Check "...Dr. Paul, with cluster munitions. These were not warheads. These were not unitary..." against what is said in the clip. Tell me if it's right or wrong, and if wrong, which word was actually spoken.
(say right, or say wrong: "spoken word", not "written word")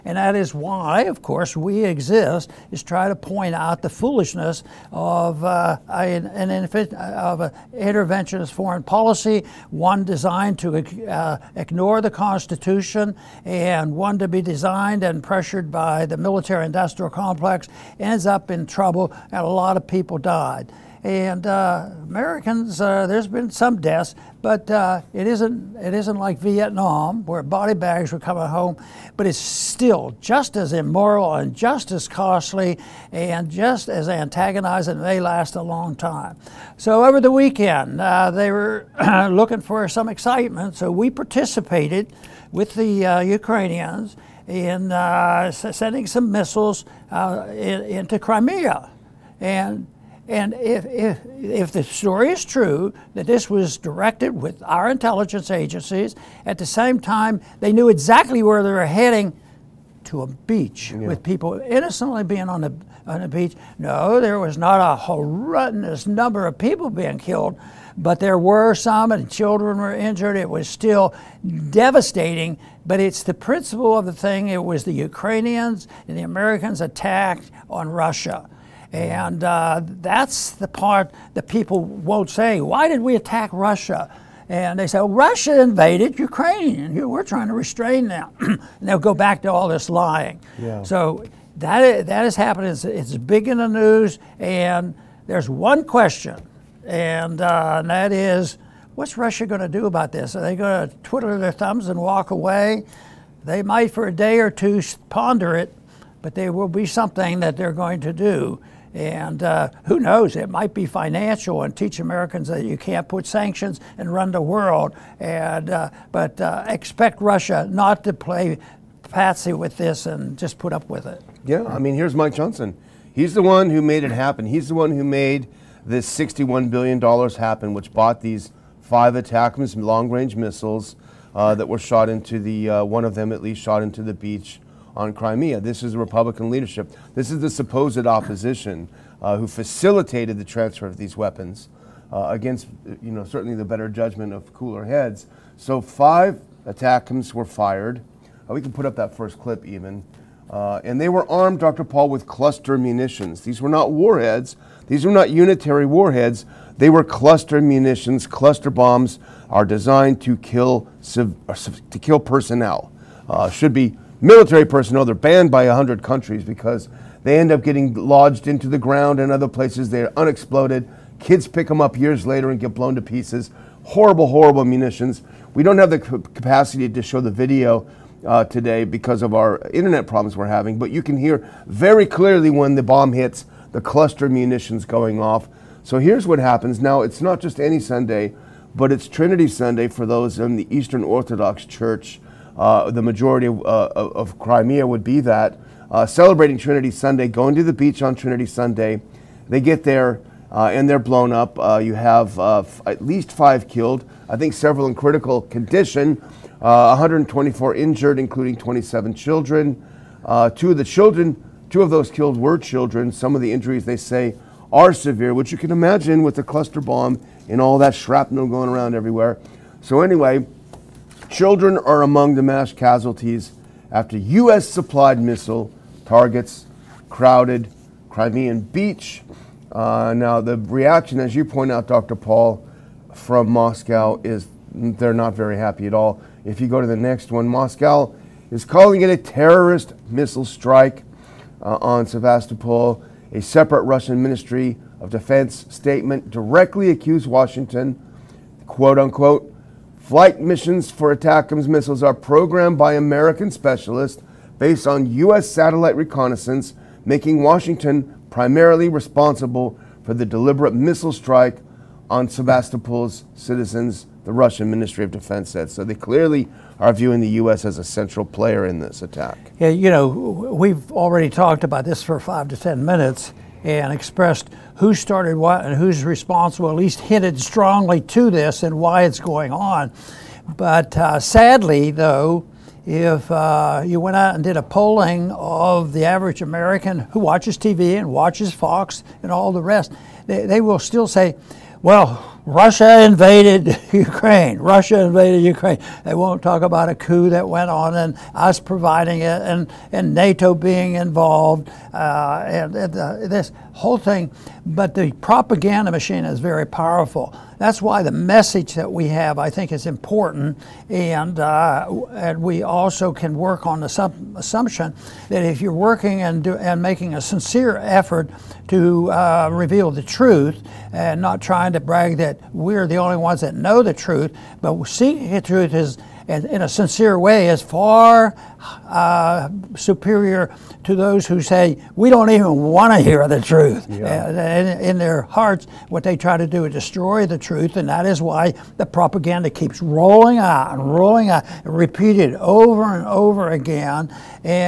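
right.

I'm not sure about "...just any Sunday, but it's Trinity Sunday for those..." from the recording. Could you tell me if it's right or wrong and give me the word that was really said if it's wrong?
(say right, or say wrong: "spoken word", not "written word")
right.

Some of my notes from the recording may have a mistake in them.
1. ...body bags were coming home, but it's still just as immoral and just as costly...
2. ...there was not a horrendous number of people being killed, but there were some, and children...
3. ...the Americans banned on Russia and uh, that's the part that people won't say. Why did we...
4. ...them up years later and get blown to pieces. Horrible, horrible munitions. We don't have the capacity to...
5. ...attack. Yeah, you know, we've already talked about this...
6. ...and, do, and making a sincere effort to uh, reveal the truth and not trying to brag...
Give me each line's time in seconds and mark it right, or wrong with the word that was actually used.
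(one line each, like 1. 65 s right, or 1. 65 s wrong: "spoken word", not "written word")
1. 27 s right
2. 64 s right
3. 76 s wrong: "attacked", not "banned"
4. 171 s right
5. 269 s right
6. 316 s right.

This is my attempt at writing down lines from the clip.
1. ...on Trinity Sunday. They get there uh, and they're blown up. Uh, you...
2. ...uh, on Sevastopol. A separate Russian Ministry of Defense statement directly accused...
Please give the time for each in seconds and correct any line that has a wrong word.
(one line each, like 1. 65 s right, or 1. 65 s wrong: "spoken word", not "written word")
1. 198 s right
2. 241 s right.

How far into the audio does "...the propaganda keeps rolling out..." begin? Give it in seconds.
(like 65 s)
338 s.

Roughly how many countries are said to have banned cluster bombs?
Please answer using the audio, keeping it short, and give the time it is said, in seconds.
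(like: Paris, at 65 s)
100, at 165 s.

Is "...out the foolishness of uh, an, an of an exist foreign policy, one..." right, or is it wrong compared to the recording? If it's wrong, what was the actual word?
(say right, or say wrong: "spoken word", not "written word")
wrong: "interventionist", not "exist".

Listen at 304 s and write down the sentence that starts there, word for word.
But the propaganda machine is very powerful.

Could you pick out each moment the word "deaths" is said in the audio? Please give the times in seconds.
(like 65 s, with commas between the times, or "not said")
23 s.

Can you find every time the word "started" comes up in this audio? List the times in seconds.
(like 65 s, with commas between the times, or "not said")
274 s.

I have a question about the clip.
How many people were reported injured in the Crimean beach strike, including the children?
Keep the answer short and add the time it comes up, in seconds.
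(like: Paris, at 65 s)
124, at 206 s.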